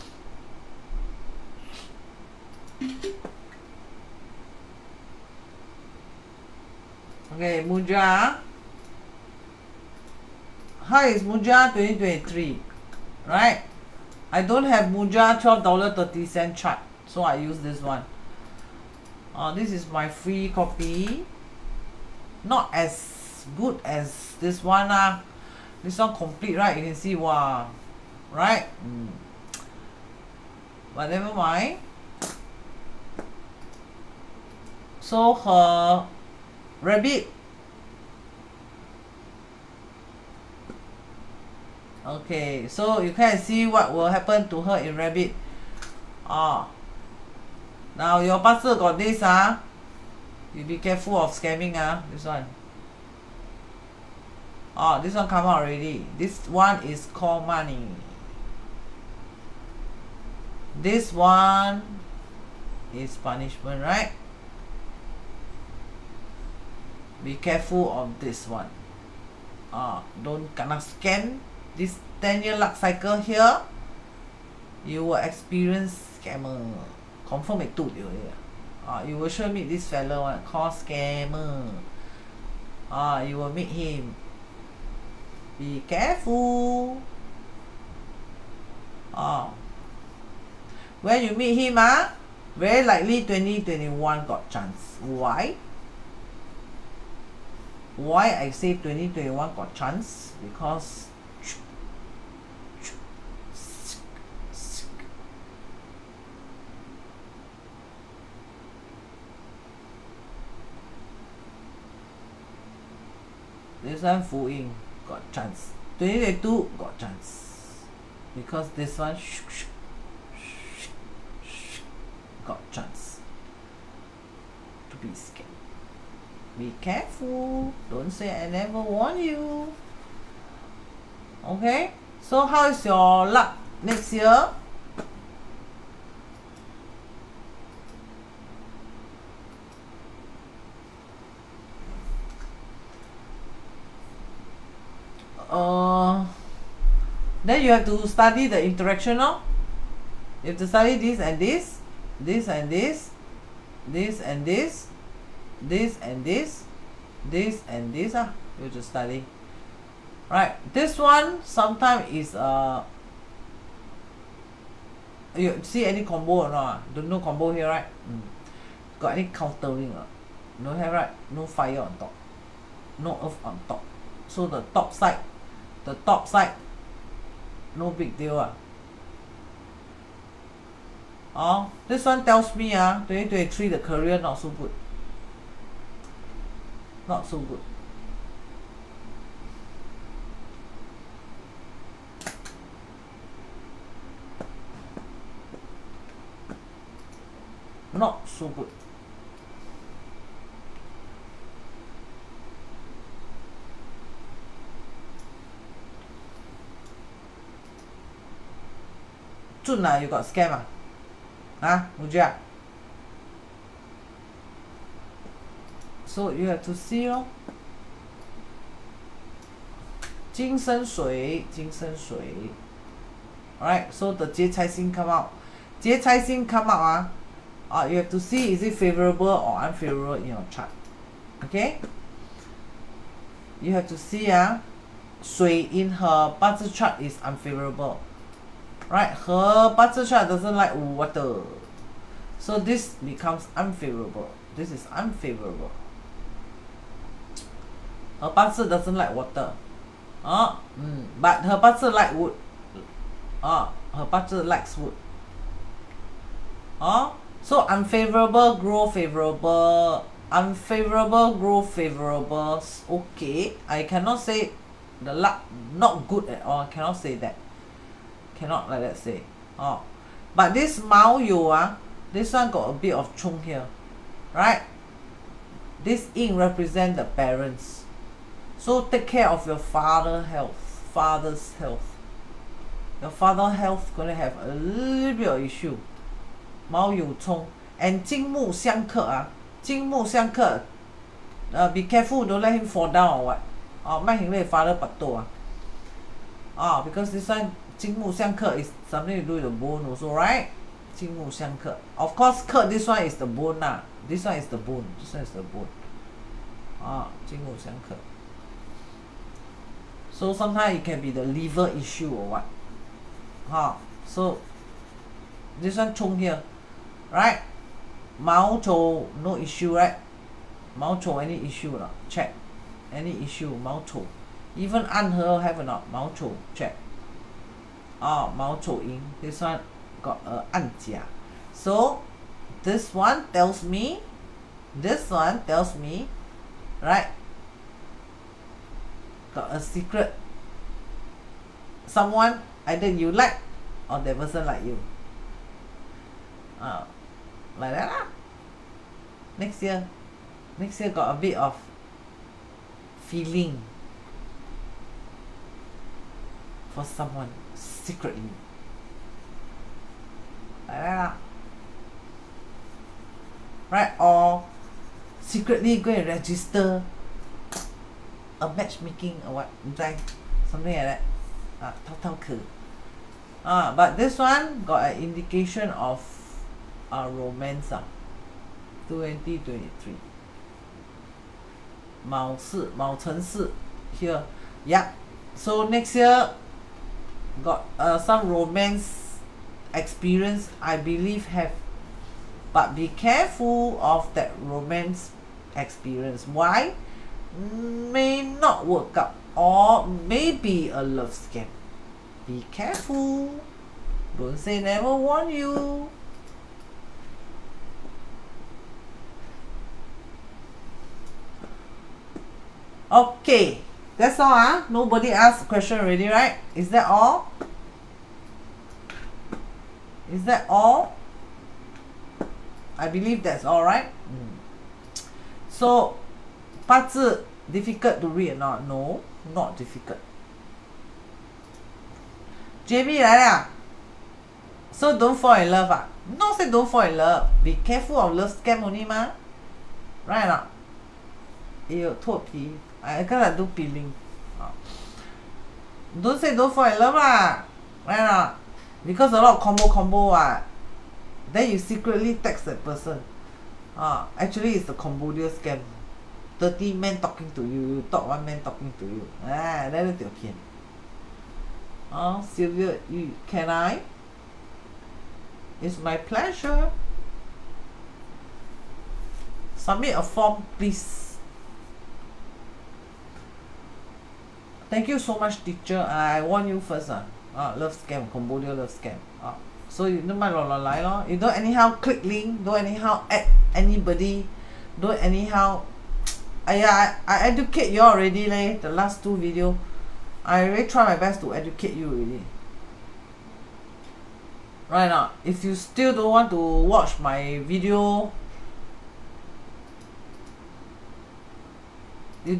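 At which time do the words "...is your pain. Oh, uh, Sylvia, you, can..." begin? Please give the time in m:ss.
7:39.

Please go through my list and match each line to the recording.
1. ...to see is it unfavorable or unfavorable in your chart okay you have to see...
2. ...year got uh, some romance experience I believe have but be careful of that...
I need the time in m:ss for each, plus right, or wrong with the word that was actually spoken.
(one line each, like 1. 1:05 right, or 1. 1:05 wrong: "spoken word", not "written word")
1. 3:48 wrong: "favorable", not "unfavorable"
2. 6:25 right.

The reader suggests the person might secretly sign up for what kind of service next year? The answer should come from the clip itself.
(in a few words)
matchmaking.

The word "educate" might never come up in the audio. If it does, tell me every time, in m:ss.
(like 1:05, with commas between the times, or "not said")
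8:07, 8:11.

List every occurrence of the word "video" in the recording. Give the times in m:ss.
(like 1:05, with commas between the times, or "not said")
8:09, 8:17.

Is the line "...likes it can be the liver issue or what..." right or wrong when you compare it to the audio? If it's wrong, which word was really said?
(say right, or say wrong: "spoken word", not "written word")
wrong: "sometimes", not "likes".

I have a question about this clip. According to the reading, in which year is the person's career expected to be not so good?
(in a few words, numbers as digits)
2023.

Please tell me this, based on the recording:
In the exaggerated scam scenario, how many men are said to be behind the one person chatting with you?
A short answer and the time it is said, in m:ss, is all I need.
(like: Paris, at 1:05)
30, at 7:36.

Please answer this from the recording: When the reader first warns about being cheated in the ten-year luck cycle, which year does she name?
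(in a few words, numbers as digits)
2021.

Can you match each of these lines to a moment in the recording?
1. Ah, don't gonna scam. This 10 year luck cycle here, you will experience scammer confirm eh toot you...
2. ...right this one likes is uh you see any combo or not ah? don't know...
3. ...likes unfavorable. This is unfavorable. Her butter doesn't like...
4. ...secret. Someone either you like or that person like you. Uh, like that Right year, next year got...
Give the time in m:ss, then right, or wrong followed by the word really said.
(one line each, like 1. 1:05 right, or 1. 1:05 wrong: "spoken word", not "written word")
1. 1:09 right
2. 2:40 wrong: "sometimes", not "likes"
3. 4:03 wrong: "becomes", not "likes"
4. 5:39 wrong: "Next", not "Right".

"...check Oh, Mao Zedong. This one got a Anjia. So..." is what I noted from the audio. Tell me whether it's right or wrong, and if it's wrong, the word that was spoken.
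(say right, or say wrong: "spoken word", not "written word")
right.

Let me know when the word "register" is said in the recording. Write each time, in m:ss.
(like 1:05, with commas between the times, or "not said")
6:06.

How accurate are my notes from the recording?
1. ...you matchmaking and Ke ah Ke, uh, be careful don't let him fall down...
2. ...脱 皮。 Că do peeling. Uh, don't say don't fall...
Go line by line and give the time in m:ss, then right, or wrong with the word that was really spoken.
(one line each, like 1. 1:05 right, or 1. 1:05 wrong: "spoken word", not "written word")
1. 4:46 wrong: "chung", not "matchmaking"
2. 7:22 right.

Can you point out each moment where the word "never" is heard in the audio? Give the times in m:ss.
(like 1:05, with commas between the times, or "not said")
0:31, 2:08, 6:44.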